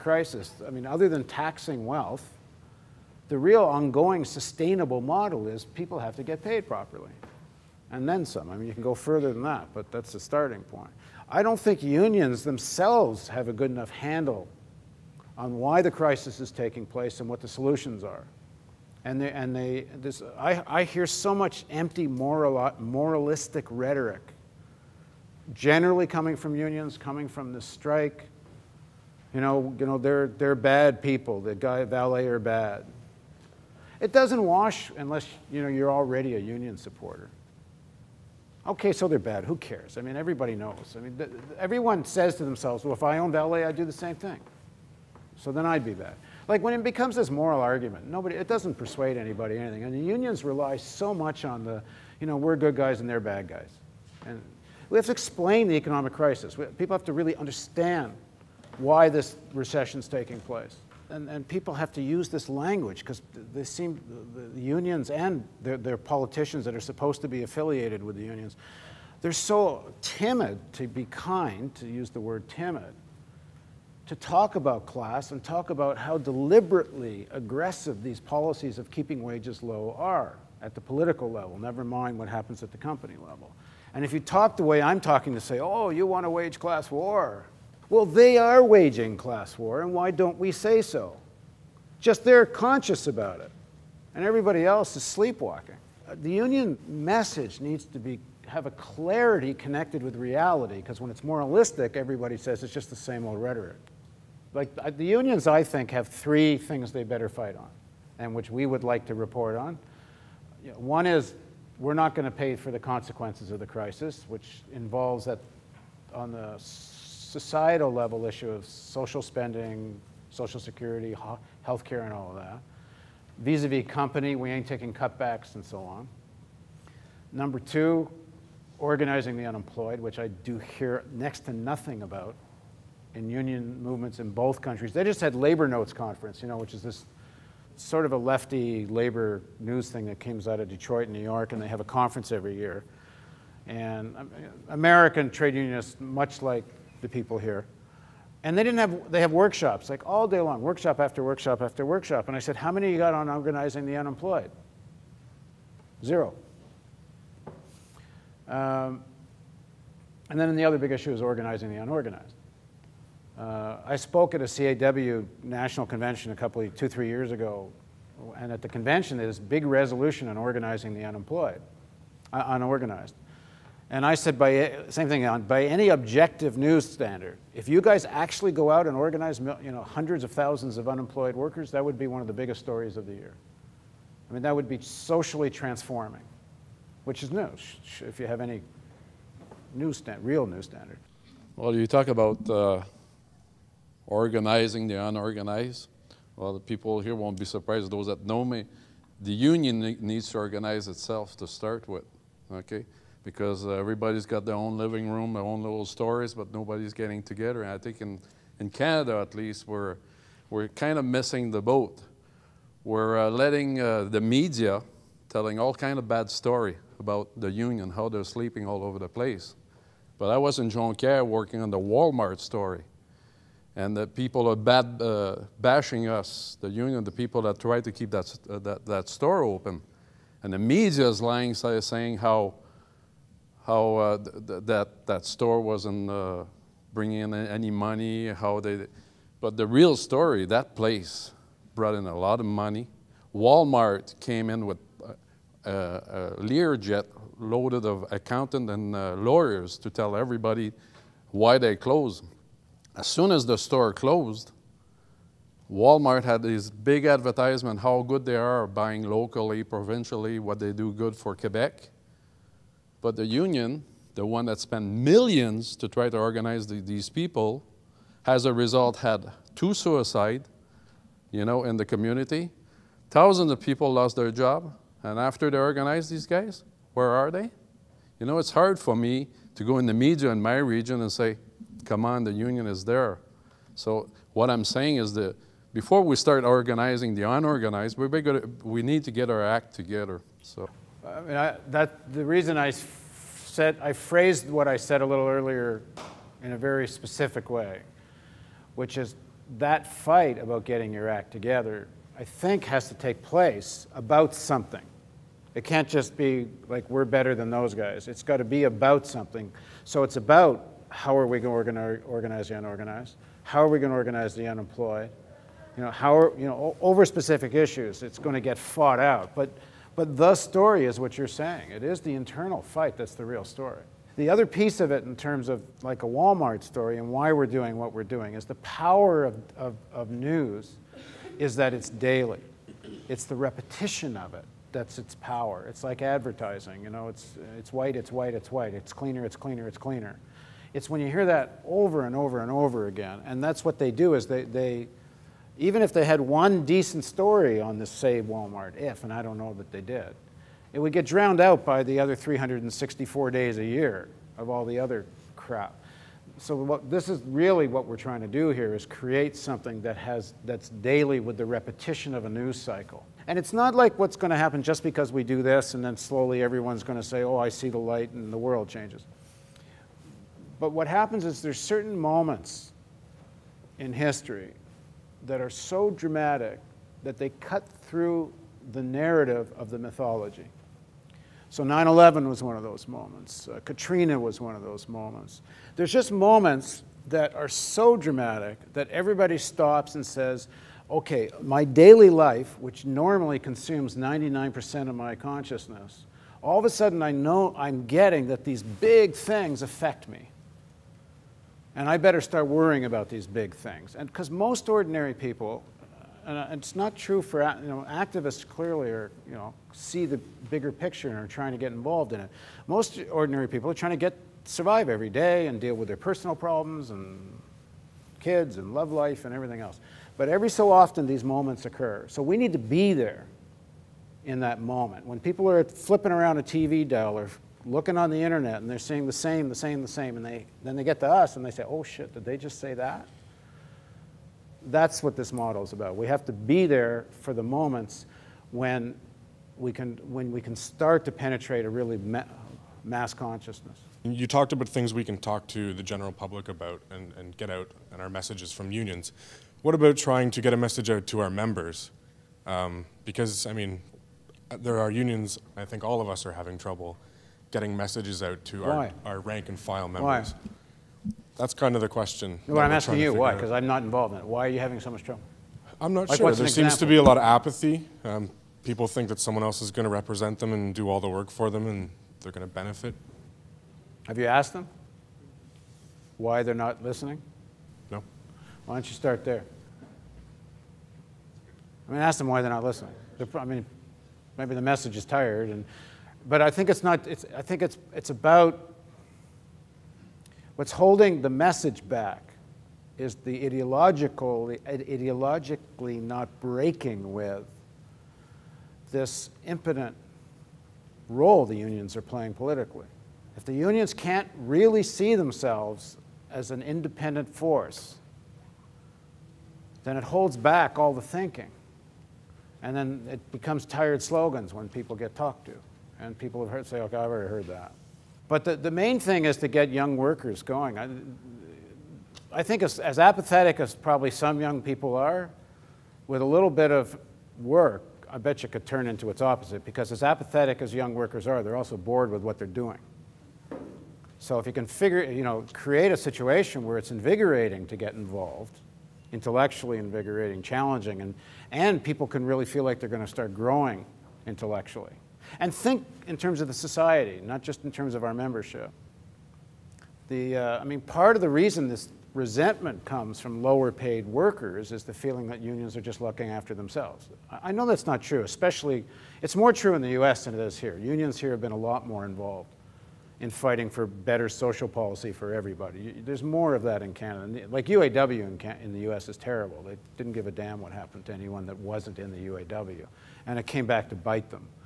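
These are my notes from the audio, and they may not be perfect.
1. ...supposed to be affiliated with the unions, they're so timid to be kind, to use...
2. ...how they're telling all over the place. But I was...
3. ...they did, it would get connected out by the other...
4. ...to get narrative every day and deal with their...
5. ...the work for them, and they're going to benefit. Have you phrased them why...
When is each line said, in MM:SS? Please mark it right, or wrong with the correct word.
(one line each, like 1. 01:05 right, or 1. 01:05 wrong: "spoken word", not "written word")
1. 01:06 right
2. 03:37 wrong: "sleeping", not "telling"
3. 05:49 wrong: "drowned", not "connected"
4. 06:53 wrong: "survive", not "narrative"
5. 07:51 wrong: "asked", not "phrased".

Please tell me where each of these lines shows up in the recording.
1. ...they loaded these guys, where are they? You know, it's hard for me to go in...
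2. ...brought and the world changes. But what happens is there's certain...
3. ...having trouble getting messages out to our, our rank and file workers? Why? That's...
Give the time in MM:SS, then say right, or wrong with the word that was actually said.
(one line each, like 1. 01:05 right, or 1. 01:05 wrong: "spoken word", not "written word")
1. 04:35 wrong: "organized", not "loaded"
2. 06:07 wrong: "light", not "brought"
3. 07:36 wrong: "members", not "workers".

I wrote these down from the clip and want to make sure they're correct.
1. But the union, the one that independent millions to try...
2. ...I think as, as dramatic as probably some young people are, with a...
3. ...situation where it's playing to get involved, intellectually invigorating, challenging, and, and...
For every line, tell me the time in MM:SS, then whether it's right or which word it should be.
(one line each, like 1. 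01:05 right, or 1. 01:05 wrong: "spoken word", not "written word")
1. 04:23 wrong: "spent", not "independent"
2. 08:42 wrong: "apathetic", not "dramatic"
3. 08:55 wrong: "invigorating", not "playing".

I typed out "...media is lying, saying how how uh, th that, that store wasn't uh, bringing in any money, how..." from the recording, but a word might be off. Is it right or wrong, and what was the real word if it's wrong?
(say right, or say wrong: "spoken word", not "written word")
right.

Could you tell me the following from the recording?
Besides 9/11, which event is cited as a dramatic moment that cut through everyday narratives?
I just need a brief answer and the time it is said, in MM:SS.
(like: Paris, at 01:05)
Katrina, at 06:23.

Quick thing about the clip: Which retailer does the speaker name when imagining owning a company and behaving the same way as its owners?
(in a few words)
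LA.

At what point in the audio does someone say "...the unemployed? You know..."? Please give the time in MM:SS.
05:14.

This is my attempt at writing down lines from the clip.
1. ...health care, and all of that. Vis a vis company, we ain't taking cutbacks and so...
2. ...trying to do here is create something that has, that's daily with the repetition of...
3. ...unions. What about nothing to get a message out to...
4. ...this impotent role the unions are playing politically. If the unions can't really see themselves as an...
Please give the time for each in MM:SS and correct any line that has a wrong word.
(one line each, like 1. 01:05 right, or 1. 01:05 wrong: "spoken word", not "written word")
1. 02:01 right
2. 05:57 right
3. 07:28 wrong: "trying", not "nothing"
4. 08:18 right.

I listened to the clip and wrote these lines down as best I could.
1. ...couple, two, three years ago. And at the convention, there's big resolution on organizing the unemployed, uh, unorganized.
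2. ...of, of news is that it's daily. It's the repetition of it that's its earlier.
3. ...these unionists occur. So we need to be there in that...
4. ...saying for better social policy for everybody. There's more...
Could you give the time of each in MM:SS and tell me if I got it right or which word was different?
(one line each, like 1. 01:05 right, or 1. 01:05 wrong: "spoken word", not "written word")
1. 02:46 right
2. 05:29 wrong: "power", not "earlier"
3. 07:01 wrong: "moments", not "unionists"
4. 09:23 wrong: "fighting", not "saying".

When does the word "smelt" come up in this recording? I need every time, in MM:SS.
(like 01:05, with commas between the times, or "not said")
not said.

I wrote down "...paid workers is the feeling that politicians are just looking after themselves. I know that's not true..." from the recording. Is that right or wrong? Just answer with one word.
wrong.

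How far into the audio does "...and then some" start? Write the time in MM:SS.
00:07.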